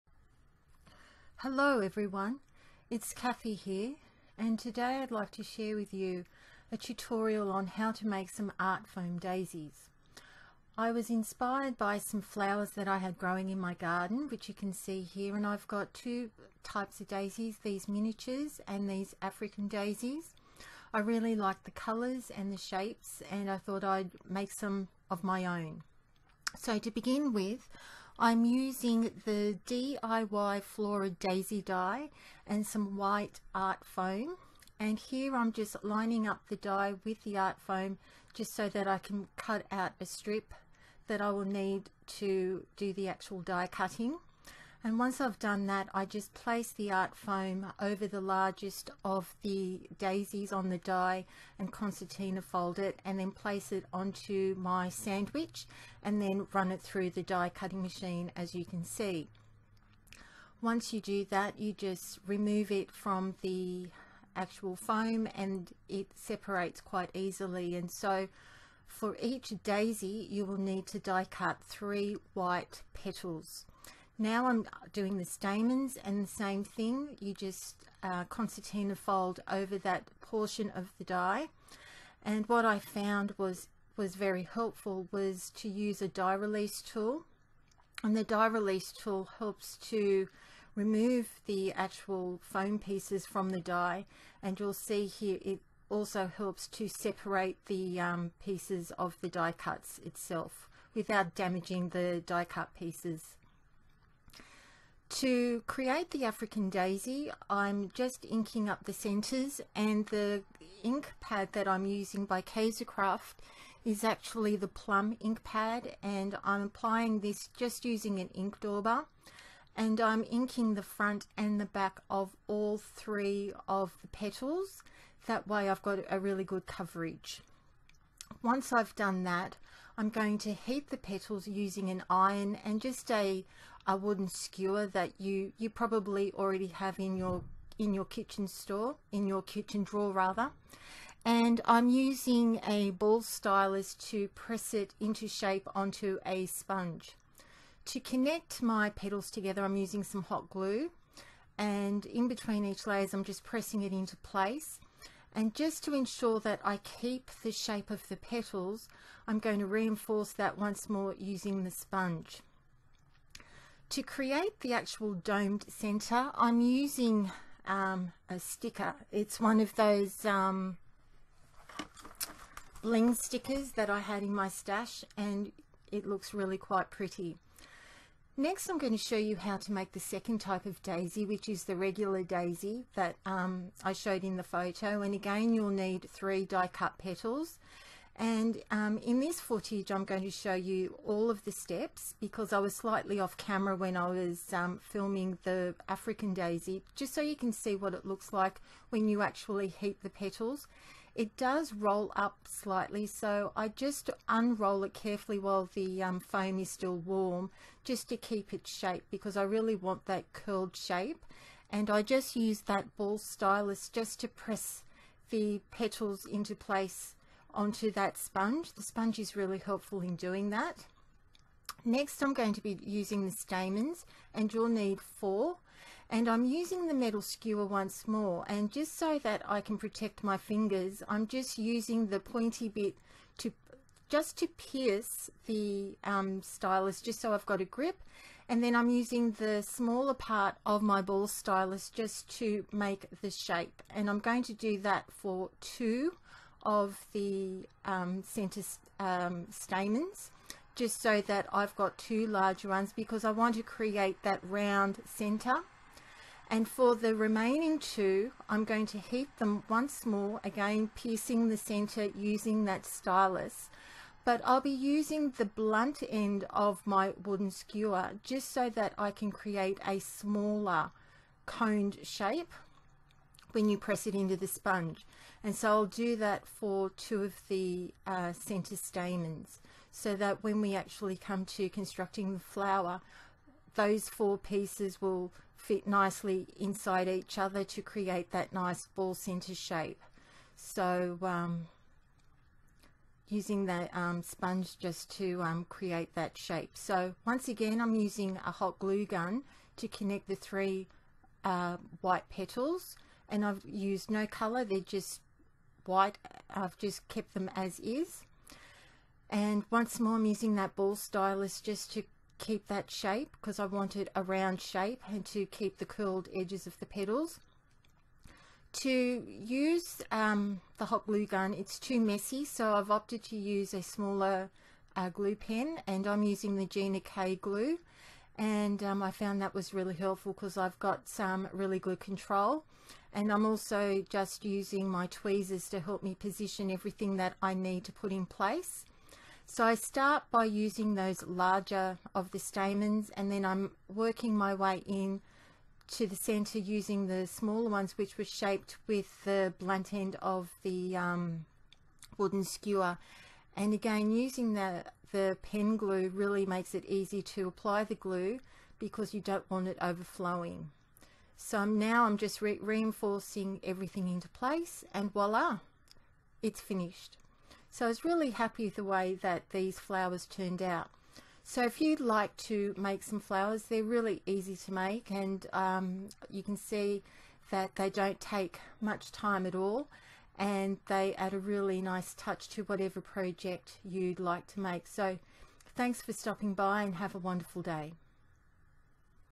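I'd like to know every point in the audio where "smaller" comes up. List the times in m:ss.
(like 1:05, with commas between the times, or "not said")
3:59, 4:29, 5:23, 5:47.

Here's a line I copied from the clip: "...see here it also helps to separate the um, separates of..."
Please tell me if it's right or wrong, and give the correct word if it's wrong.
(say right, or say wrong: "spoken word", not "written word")
wrong: "pieces", not "separates".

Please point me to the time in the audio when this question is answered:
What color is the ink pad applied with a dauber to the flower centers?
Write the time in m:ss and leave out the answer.
1:54.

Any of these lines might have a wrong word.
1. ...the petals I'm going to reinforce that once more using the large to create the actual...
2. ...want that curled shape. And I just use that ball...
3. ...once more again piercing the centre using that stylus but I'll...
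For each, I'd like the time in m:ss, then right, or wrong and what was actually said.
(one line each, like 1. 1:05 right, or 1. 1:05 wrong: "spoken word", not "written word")
1. 2:38 wrong: "sponge", not "large"
2. 3:29 right
3. 4:19 right.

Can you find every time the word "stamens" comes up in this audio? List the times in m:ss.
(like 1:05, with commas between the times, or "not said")
1:15, 3:43, 4:09, 4:38, 5:42.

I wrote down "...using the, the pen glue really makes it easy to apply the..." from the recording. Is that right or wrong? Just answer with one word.
right.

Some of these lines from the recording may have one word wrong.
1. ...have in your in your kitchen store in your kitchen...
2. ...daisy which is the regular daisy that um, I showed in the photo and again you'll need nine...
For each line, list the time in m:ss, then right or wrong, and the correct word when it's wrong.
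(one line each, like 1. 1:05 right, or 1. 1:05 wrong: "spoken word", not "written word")
1. 2:16 right
2. 3:00 wrong: "three", not "nine".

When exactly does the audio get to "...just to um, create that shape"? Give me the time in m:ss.
4:54.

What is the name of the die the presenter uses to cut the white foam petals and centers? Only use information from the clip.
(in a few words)
DIY Flora Daisy.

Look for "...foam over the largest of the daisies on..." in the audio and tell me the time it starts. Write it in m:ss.
0:47.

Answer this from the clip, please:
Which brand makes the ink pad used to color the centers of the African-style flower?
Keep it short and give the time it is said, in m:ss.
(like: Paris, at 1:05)
Kaisercraft, at 1:52.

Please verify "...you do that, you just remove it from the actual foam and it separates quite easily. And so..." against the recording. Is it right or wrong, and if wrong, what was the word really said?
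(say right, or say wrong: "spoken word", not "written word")
right.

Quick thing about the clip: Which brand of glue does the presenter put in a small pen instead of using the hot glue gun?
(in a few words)
Gina K.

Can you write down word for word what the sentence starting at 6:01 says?
So now I'm just re reinforcing everything into place and voila, it's finished.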